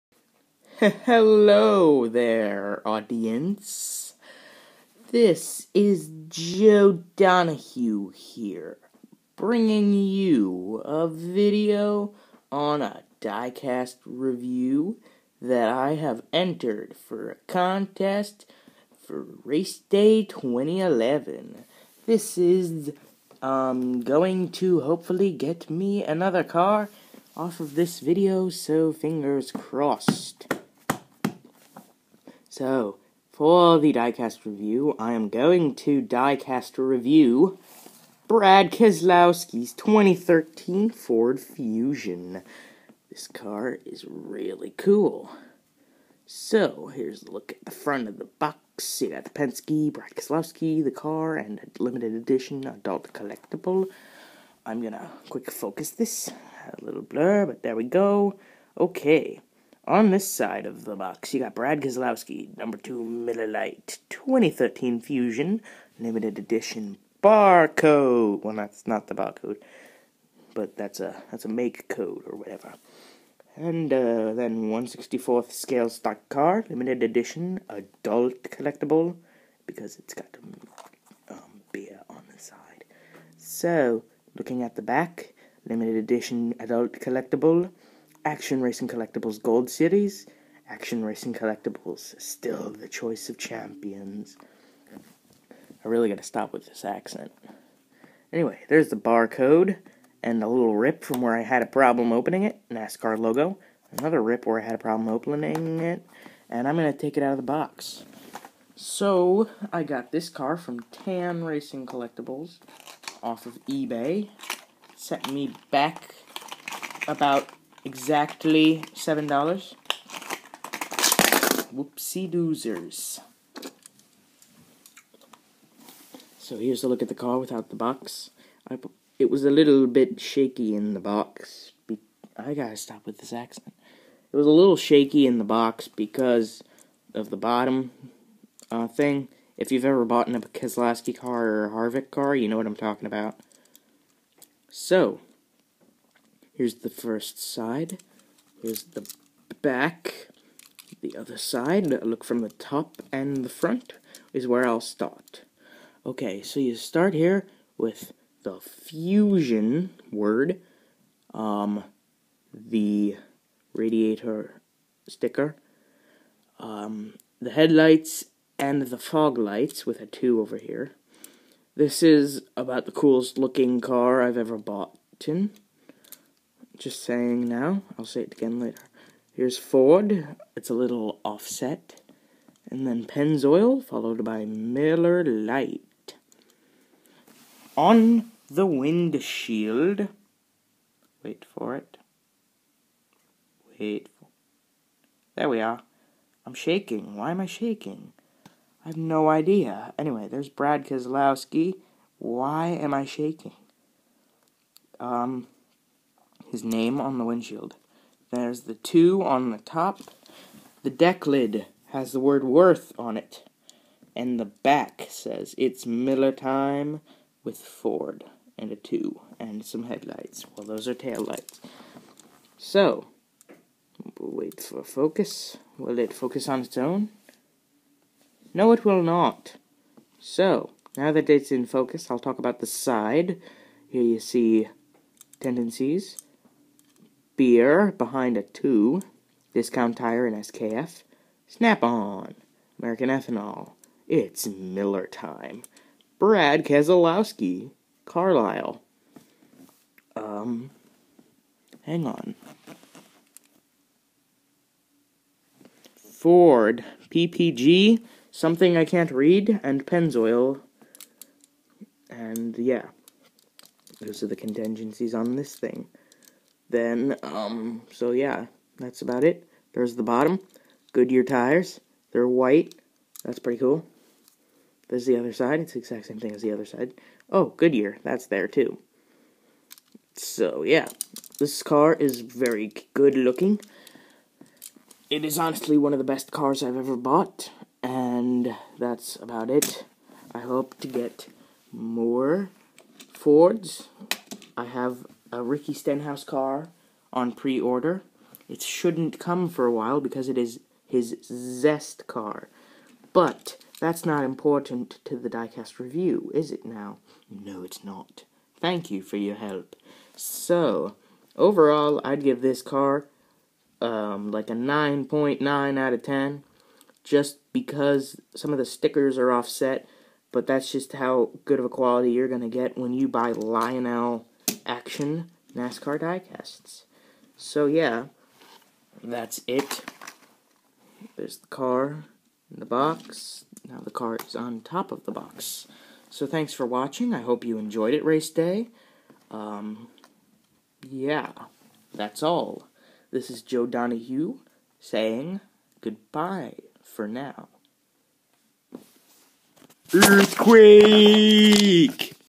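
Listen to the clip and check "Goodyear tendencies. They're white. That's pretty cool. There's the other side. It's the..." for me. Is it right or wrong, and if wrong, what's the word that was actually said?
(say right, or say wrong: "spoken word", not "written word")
wrong: "tires", not "tendencies".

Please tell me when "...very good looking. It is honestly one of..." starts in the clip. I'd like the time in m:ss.
4:42.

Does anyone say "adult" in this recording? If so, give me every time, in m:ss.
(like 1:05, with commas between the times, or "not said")
0:52, 1:17, 1:26.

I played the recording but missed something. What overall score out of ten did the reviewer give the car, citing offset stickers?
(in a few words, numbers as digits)
9.9.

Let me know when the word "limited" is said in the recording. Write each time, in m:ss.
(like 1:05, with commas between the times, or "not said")
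0:51, 1:05, 1:16, 1:25.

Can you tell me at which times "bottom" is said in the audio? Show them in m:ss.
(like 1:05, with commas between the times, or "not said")
2:17, 4:30.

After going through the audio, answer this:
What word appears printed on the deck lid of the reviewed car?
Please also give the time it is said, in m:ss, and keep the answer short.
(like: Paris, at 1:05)
worth, at 3:32.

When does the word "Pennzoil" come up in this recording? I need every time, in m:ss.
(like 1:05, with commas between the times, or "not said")
3:03, 4:19.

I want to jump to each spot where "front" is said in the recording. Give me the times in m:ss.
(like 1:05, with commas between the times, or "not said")
0:47, 2:33.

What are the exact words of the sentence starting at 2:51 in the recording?
This is about the coolest looking car I've ever bought.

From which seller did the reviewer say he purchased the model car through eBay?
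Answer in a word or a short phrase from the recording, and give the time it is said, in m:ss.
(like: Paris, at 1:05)
Tan Racing Collectibles, at 1:50.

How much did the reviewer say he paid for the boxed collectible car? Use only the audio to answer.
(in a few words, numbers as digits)
7 dollars.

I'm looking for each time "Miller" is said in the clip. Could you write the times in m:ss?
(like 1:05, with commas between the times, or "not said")
1:03, 3:04, 3:35, 4:04.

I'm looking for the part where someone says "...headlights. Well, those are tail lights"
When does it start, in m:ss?
3:39.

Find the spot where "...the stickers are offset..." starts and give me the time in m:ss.
5:18.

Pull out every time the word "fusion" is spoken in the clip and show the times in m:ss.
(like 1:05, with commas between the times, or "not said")
0:41, 1:05, 2:38.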